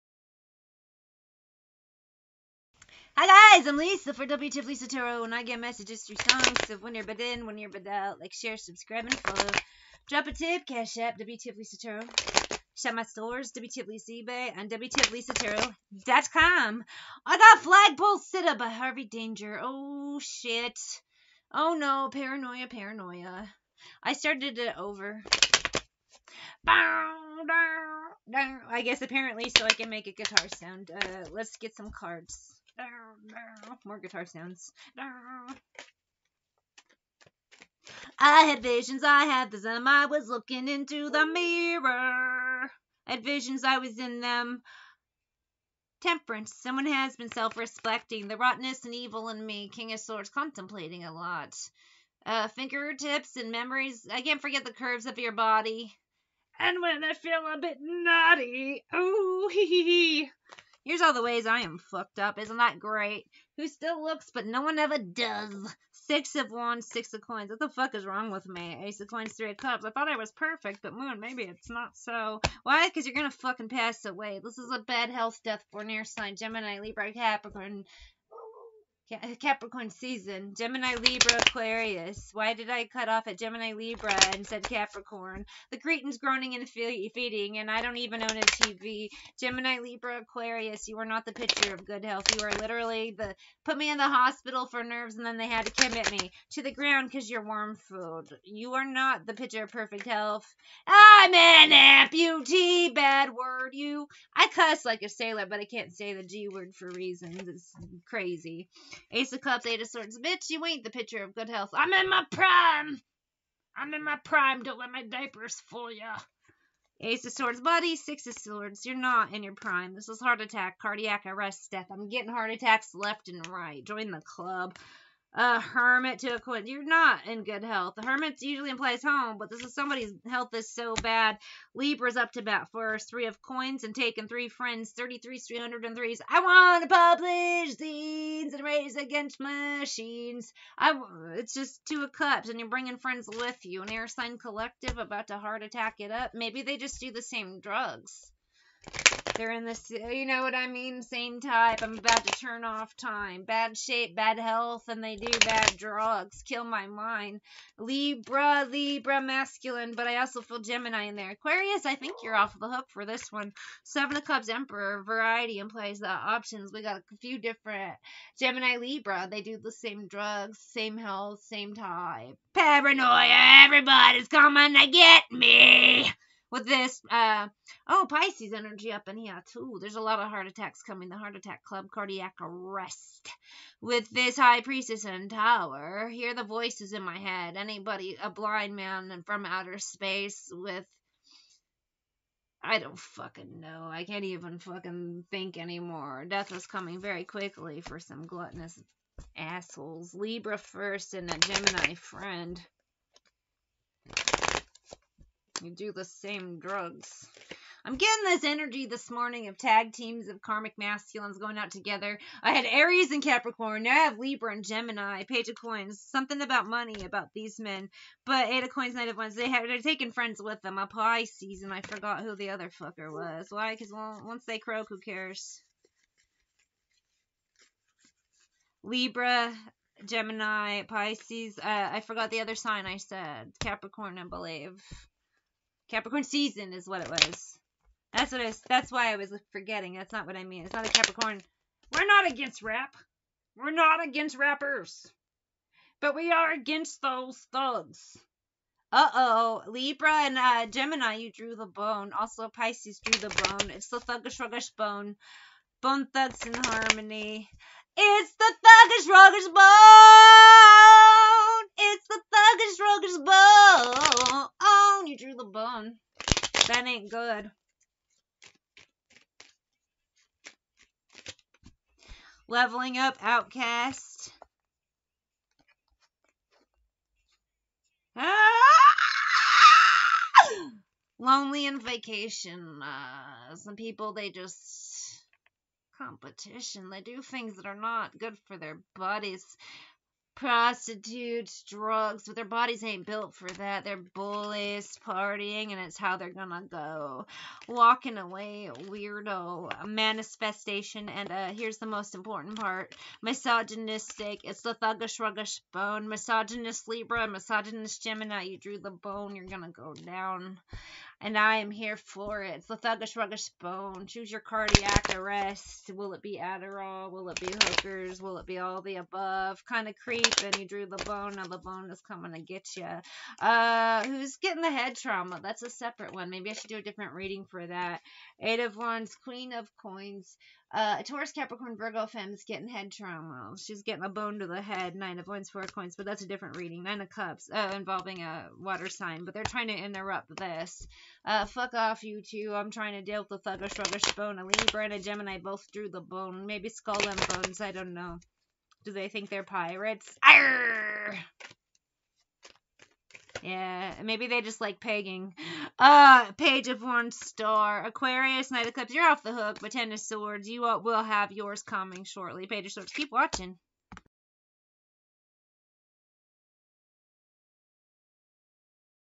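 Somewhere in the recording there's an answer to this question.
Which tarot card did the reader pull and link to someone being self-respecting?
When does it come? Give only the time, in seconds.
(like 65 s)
46 s.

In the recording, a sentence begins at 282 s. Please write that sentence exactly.
Uh, some people, they just competition.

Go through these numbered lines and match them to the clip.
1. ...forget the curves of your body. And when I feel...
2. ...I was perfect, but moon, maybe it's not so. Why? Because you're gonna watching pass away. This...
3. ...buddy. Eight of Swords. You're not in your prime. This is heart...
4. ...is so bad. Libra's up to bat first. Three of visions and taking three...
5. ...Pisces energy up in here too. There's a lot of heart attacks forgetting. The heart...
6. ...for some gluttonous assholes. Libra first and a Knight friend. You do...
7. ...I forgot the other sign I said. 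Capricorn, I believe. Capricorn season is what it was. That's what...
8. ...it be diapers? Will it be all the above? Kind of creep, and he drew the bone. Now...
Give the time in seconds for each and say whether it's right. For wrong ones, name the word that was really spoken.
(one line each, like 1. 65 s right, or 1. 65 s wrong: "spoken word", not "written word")
1. 54 s right
2. 70 s wrong: "fucking", not "watching"
3. 117 s wrong: "Six", not "Eight"
4. 130 s wrong: "coins", not "visions"
5. 178 s wrong: "coming", not "forgetting"
6. 197 s wrong: "Gemini", not "Knight"
7. 231 s right
8. 317 s wrong: "hookers", not "diapers".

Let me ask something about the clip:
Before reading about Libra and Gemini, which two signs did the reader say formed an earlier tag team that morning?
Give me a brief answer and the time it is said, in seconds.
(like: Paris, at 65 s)
Aries and Capricorn, at 212 s.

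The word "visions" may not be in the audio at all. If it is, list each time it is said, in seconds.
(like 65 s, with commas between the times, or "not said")
38 s, 43 s.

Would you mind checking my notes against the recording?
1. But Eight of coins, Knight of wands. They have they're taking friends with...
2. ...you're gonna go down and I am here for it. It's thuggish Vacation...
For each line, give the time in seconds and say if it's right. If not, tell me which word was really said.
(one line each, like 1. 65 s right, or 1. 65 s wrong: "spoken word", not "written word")
1. 218 s right
2. 309 s wrong: "Ruggish", not "Vacation".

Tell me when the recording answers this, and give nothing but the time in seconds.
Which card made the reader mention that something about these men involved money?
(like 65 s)
215 s.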